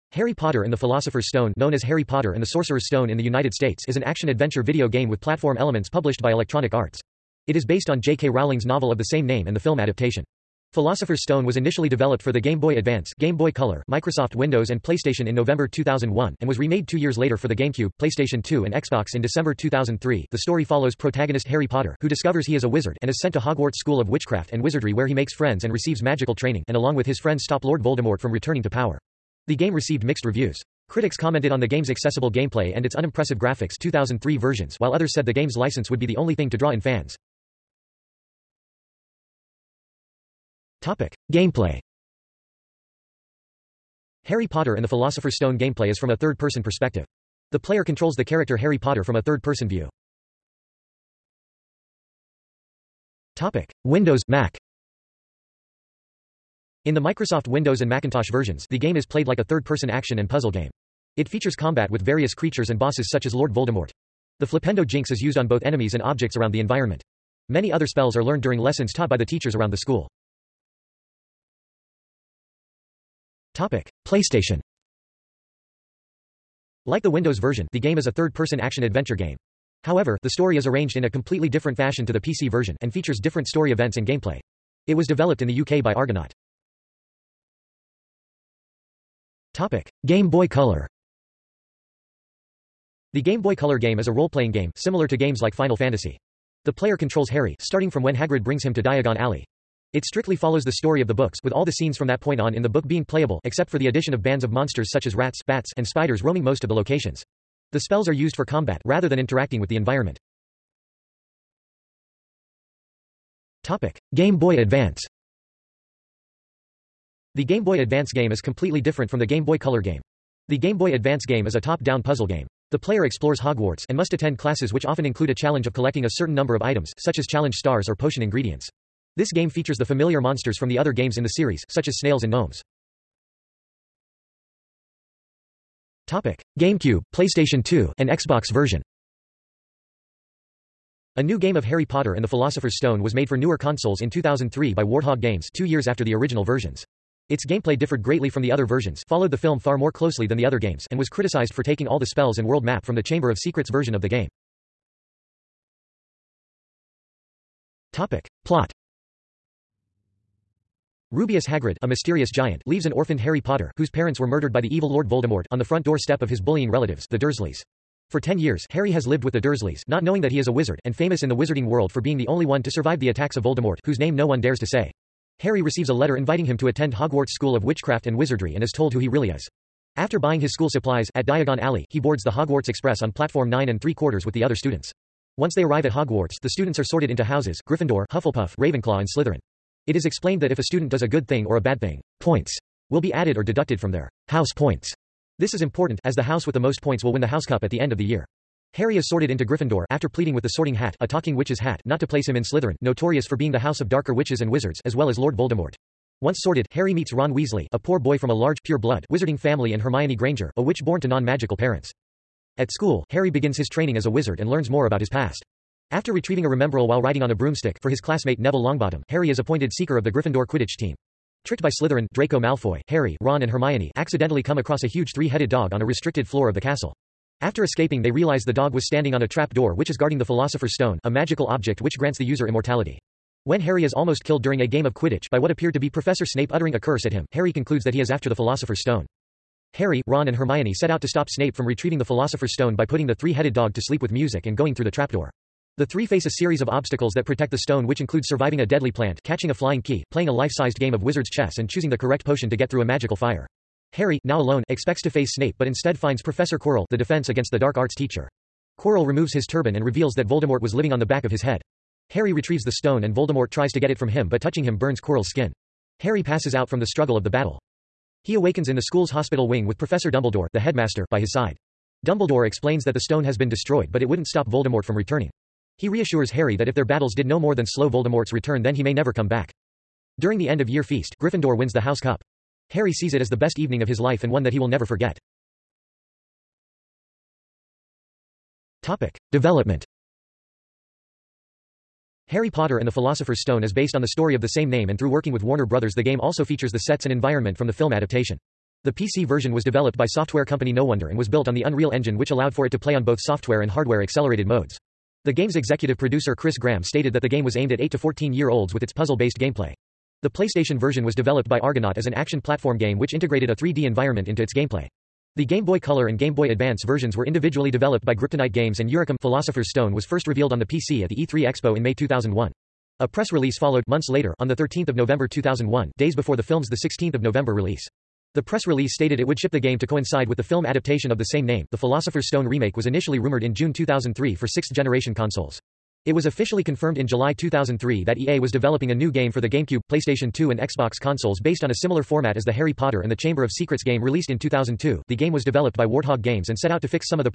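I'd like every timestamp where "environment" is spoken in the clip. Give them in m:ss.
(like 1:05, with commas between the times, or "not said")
1:06, 1:49, 4:57, 5:13.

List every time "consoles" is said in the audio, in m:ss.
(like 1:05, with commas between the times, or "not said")
2:23, 5:35, 5:40.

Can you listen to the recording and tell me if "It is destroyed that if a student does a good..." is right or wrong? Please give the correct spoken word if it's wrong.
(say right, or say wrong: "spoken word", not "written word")
wrong: "explained", not "destroyed".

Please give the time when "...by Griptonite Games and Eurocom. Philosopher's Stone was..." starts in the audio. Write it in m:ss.
5:18.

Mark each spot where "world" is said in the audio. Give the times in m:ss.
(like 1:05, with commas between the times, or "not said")
2:32, 2:51.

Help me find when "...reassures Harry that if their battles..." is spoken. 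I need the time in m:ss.
4:35.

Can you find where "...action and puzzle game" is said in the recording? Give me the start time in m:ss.
0:59.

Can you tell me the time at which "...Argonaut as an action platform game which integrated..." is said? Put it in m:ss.
5:11.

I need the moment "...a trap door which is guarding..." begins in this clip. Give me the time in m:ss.
3:49.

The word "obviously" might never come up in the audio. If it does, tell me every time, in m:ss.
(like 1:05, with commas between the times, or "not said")
not said.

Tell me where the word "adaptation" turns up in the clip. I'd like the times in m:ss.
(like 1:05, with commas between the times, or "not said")
0:09, 4:57, 5:30.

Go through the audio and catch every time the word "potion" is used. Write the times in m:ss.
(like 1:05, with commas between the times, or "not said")
2:07, 4:12.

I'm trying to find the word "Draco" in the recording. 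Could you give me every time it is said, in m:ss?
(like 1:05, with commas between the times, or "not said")
3:42.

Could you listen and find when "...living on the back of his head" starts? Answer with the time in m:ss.
4:20.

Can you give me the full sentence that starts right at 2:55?
Harry receives a letter inviting him to attend Hogwarts School of Witchcraft and Wizardry and is told who he really is.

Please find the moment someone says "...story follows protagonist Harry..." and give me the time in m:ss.
0:20.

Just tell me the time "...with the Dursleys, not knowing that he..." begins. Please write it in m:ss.
2:49.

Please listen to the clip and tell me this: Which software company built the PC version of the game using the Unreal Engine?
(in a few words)
No Wonder.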